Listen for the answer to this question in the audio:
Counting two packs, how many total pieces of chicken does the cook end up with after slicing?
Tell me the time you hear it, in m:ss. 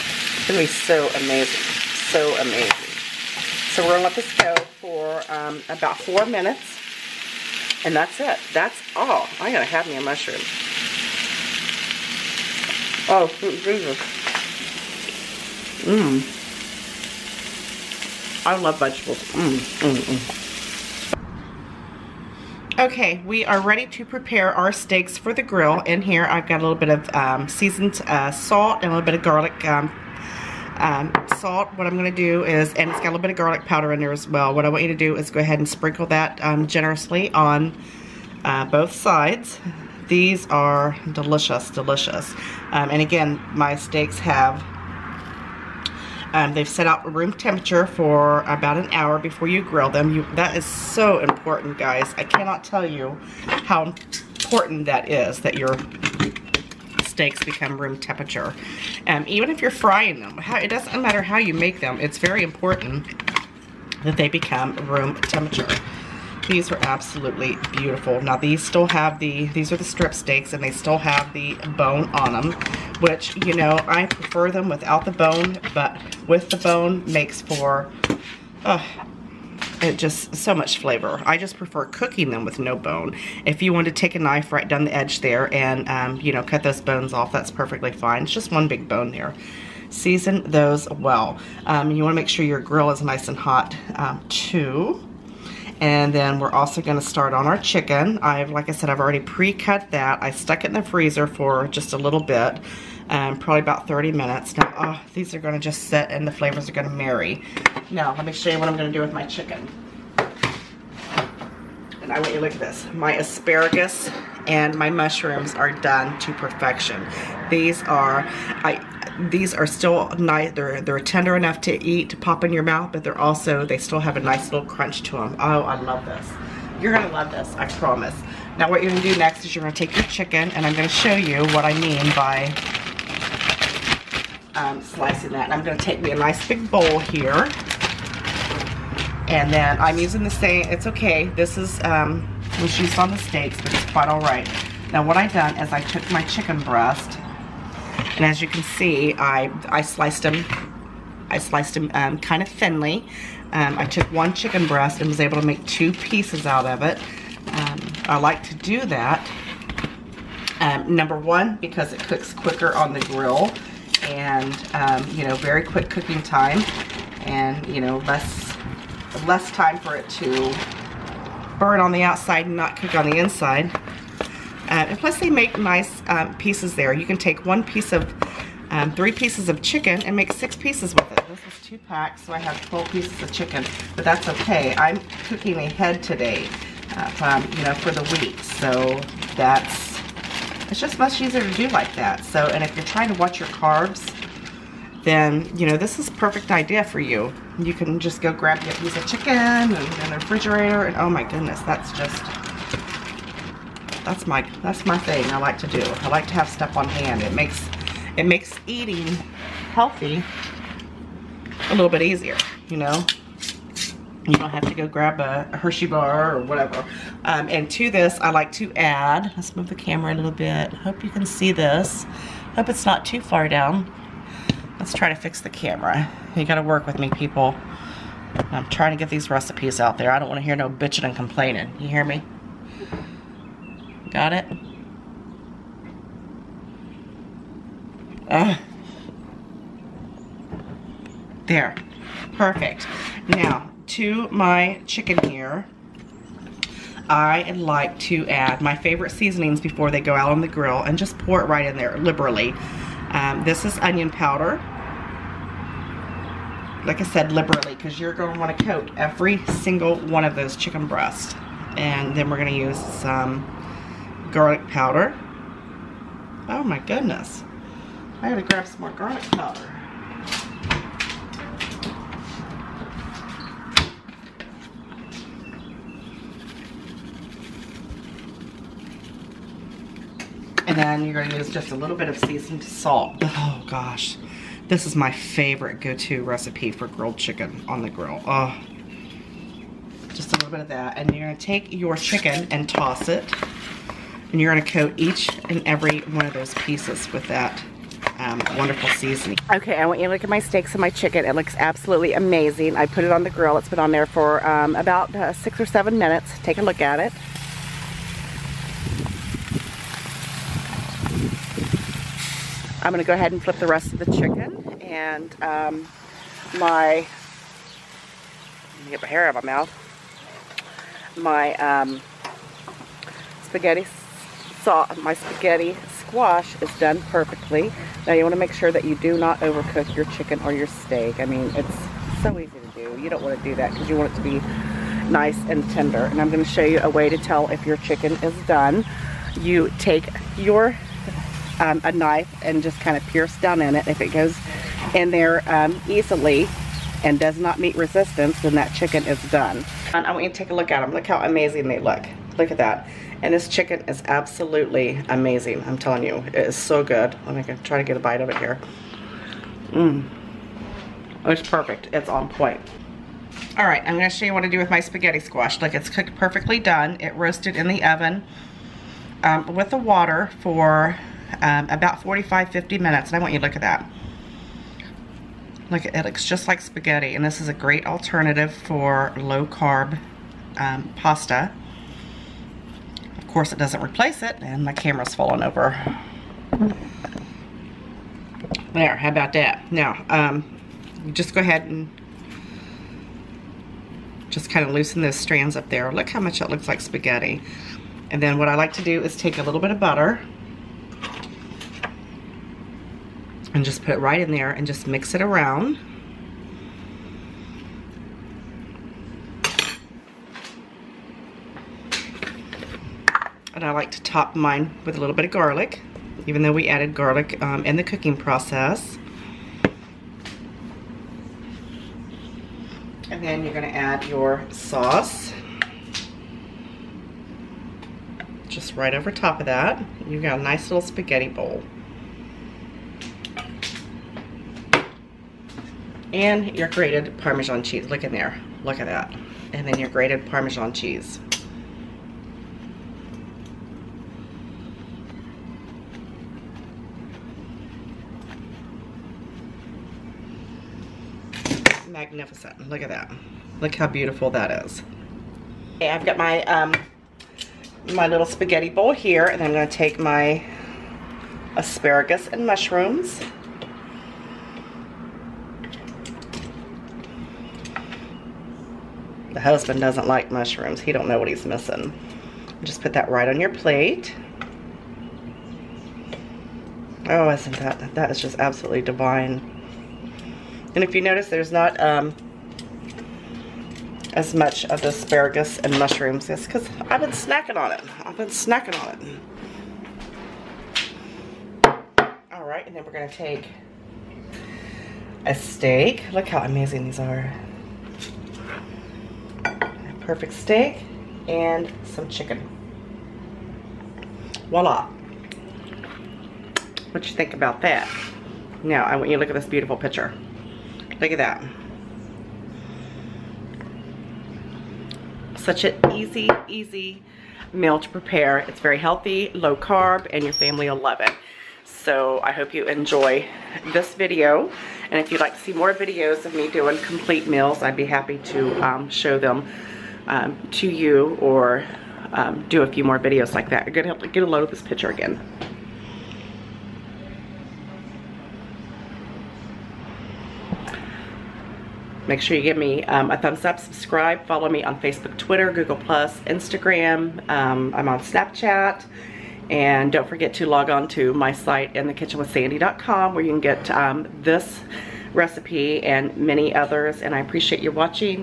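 3:02.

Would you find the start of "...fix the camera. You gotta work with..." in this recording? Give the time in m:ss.
3:45.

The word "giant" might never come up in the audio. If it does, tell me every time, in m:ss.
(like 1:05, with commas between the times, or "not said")
not said.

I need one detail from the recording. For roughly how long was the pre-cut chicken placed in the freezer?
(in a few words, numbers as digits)
30 minutes.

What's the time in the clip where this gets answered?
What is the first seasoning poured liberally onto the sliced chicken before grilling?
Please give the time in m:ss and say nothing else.
4:13.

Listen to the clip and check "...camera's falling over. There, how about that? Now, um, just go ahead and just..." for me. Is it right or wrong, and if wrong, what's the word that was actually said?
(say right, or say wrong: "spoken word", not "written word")
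right.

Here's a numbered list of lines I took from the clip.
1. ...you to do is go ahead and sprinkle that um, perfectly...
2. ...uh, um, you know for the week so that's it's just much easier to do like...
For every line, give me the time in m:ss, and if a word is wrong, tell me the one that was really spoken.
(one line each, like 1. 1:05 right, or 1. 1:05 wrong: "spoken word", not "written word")
1. 0:34 wrong: "generously", not "perfectly"
2. 3:06 right.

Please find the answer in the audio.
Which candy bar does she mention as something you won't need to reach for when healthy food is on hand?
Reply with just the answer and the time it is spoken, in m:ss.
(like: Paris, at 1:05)
Hershey bar, at 3:35.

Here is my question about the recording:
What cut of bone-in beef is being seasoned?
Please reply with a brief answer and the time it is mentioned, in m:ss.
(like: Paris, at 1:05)
strip steaks, at 1:09.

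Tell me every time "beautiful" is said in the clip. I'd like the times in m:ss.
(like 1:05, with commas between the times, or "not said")
1:07, 7:33, 8:29.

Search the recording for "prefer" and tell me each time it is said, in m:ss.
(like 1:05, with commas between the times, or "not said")
1:14, 1:21.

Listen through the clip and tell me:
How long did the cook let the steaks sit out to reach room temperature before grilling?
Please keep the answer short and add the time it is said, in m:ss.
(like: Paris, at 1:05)
about an hour, at 0:48.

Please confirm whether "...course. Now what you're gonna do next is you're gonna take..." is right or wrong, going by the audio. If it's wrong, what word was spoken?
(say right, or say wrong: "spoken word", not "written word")
wrong: "promise", not "course".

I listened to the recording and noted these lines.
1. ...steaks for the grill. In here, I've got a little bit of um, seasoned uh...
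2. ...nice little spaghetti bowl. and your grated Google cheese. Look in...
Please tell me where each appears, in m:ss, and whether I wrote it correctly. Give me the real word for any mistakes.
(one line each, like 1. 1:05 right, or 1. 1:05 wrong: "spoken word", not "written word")
1. 0:24 right
2. 7:10 wrong: "Parmesan", not "Google".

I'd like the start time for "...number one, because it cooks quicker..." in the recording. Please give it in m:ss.
2:40.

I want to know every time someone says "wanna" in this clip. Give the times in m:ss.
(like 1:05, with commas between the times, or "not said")
3:50, 5:28, 5:33.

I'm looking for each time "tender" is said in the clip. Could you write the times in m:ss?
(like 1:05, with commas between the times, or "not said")
2:00, 5:35.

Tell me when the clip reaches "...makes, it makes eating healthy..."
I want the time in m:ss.
3:27.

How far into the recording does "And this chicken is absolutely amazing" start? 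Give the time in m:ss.
5:53.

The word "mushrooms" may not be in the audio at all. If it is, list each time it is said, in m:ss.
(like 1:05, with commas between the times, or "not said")
0:10, 1:54, 7:42, 7:50, 8:05.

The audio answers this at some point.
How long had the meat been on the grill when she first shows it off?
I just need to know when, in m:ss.
5:05.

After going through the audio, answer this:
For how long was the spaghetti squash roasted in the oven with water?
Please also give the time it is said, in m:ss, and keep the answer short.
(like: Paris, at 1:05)
45 to 50 minutes, at 6:11.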